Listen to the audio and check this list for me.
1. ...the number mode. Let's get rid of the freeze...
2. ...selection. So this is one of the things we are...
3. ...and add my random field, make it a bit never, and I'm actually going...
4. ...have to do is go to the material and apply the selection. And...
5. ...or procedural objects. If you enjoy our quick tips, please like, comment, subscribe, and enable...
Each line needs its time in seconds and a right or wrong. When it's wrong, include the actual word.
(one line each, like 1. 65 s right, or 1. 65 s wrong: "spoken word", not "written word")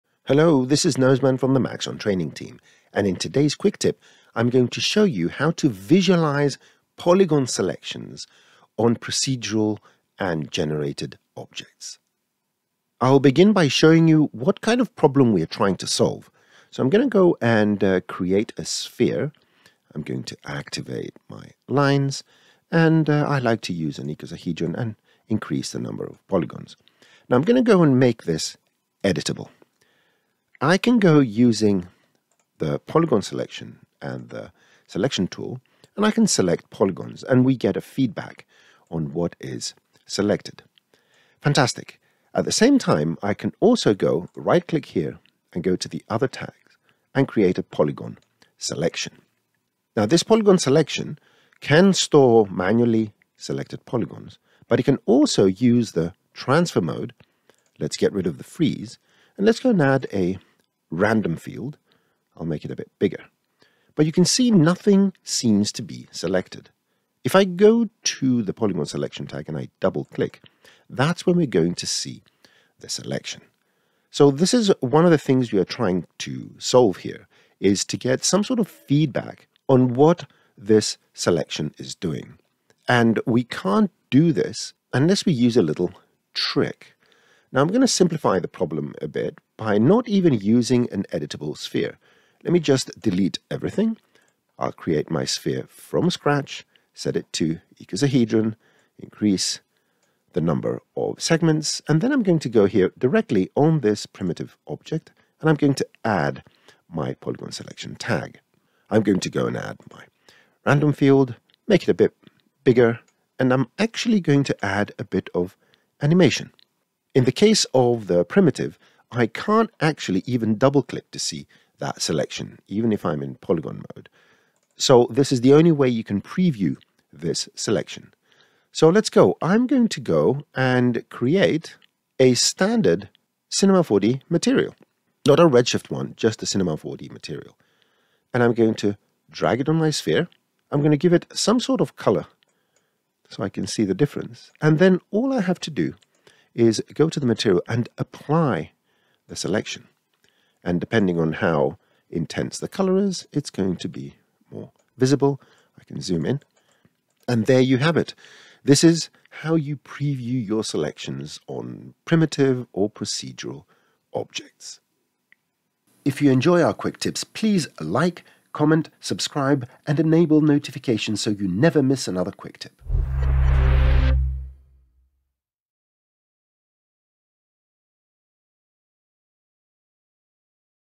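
1. 55 s wrong: "transfer", not "number"
2. 72 s right
3. 109 s wrong: "bigger", not "never"
4. 145 s right
5. 162 s right.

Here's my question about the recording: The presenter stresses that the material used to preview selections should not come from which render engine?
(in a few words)
Redshift.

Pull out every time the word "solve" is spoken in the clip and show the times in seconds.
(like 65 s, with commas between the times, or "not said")
15 s, 76 s.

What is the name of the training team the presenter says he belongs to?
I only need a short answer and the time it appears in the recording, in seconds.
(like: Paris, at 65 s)
Maxon, at 1 s.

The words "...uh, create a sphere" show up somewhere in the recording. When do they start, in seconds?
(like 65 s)
17 s.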